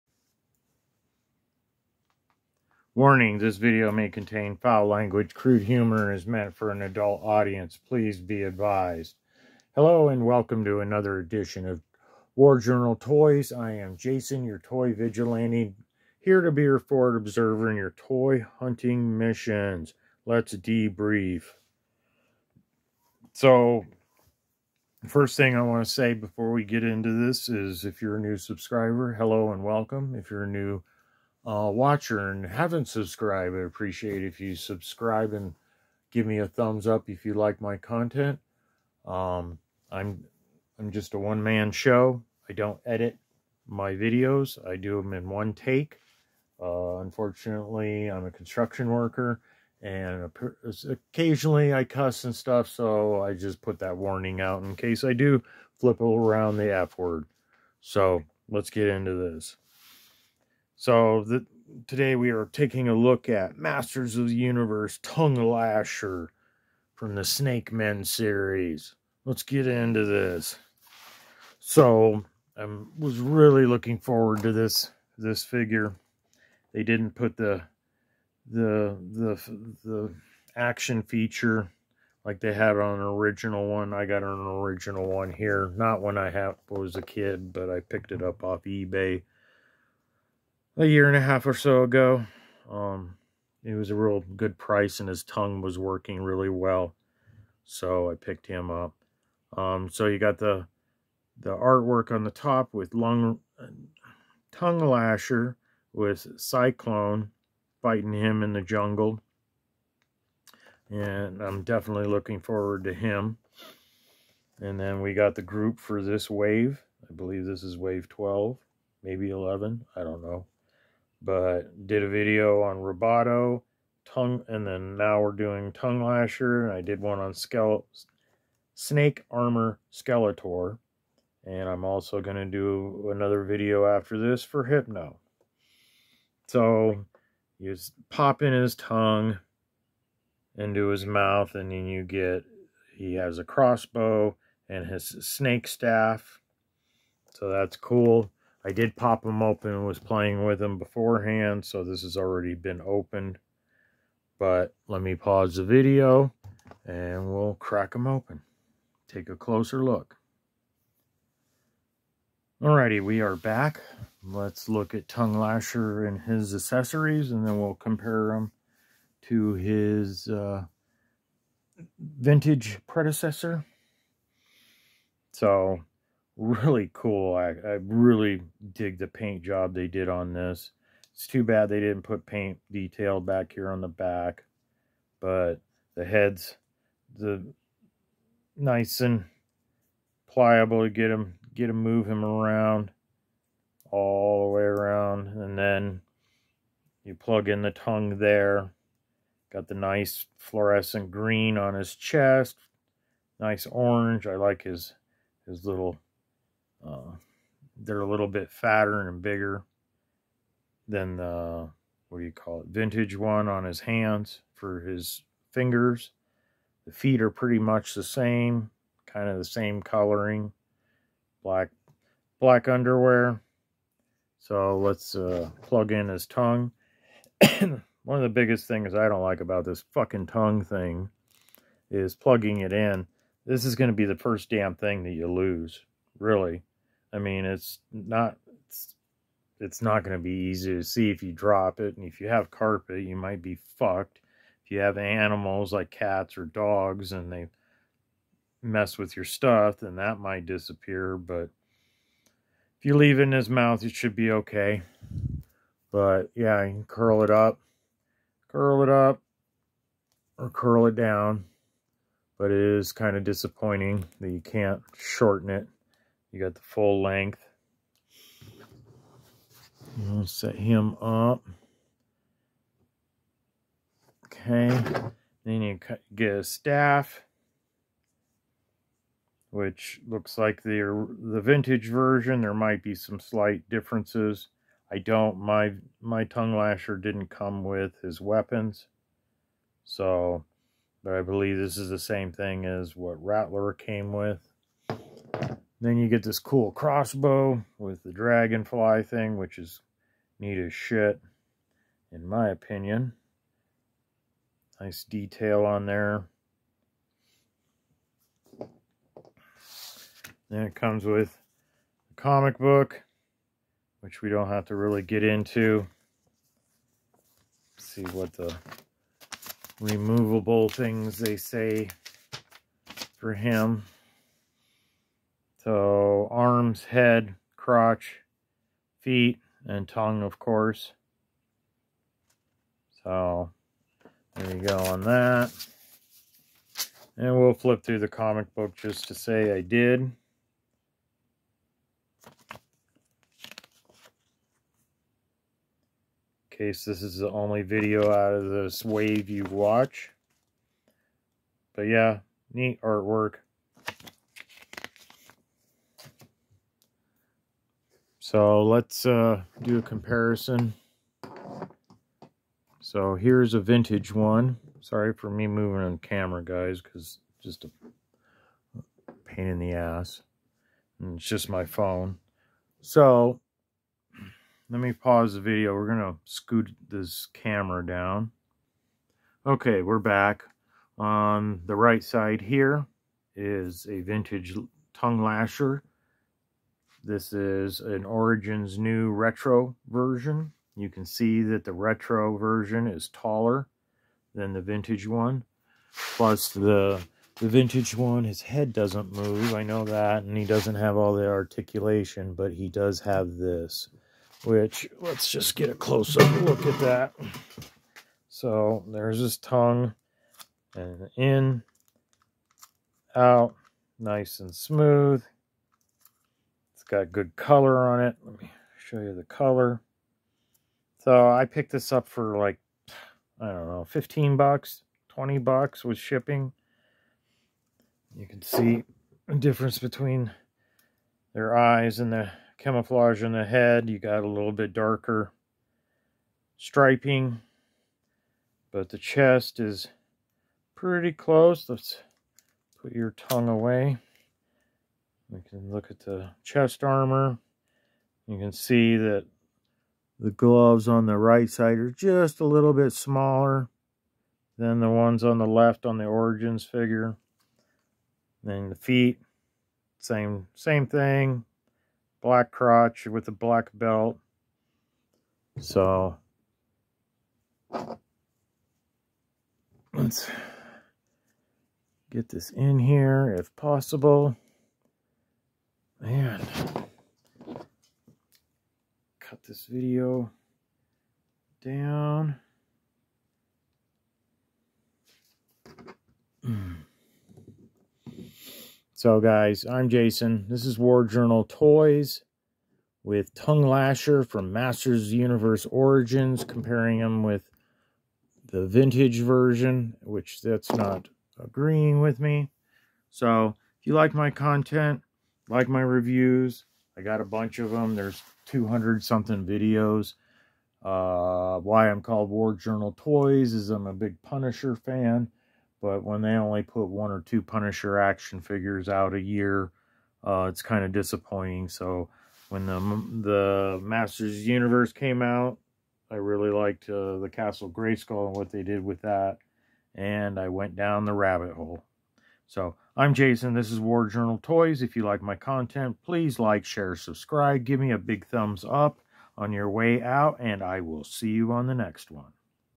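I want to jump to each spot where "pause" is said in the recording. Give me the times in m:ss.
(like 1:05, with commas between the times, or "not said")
2:35, 6:14.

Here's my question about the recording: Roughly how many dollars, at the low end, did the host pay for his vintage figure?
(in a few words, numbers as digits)
15.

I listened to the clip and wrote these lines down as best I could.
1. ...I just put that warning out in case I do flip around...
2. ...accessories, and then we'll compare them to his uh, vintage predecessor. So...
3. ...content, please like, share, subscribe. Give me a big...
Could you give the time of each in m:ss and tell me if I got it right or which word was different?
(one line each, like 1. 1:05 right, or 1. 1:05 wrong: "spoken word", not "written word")
1. 0:53 right
2. 2:46 right
3. 8:55 right.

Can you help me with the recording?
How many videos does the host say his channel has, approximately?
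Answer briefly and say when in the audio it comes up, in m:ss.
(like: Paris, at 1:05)
200 something, at 8:28.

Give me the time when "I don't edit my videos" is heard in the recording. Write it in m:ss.
0:42.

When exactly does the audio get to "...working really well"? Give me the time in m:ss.
1:35.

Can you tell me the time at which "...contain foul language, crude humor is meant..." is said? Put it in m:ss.
0:04.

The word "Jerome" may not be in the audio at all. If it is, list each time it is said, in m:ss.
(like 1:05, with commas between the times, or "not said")
not said.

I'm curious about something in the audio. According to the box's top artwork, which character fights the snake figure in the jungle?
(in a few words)
Cyclone.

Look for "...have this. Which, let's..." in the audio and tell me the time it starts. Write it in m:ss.
6:42.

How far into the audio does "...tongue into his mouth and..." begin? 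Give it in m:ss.
2:18.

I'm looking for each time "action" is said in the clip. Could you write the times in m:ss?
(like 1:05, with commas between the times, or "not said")
1:20, 8:37.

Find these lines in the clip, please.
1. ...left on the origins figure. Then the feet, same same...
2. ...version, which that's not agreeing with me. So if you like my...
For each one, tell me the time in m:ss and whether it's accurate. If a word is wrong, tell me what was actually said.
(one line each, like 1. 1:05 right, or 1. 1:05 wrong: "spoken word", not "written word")
1. 7:35 right
2. 8:19 right.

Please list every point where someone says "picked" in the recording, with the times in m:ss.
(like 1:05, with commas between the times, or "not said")
1:27, 1:38, 7:01.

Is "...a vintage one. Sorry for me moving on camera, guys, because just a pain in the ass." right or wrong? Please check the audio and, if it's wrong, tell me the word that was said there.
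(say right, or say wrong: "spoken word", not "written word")
right.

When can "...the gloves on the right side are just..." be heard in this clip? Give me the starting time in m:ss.
7:30.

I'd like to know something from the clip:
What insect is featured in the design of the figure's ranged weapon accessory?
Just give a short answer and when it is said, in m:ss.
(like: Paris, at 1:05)
dragonfly, at 4:58.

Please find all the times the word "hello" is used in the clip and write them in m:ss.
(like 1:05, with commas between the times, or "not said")
0:09, 0:29.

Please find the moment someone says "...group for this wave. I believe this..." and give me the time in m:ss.
1:55.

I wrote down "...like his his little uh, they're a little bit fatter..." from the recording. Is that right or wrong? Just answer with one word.
right.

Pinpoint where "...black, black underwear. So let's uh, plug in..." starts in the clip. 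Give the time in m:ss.
3:41.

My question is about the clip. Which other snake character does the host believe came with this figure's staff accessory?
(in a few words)
Rattlor.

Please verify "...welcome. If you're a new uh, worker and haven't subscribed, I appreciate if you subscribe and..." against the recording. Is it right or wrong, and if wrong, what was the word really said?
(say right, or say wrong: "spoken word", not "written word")
wrong: "watcher", not "worker".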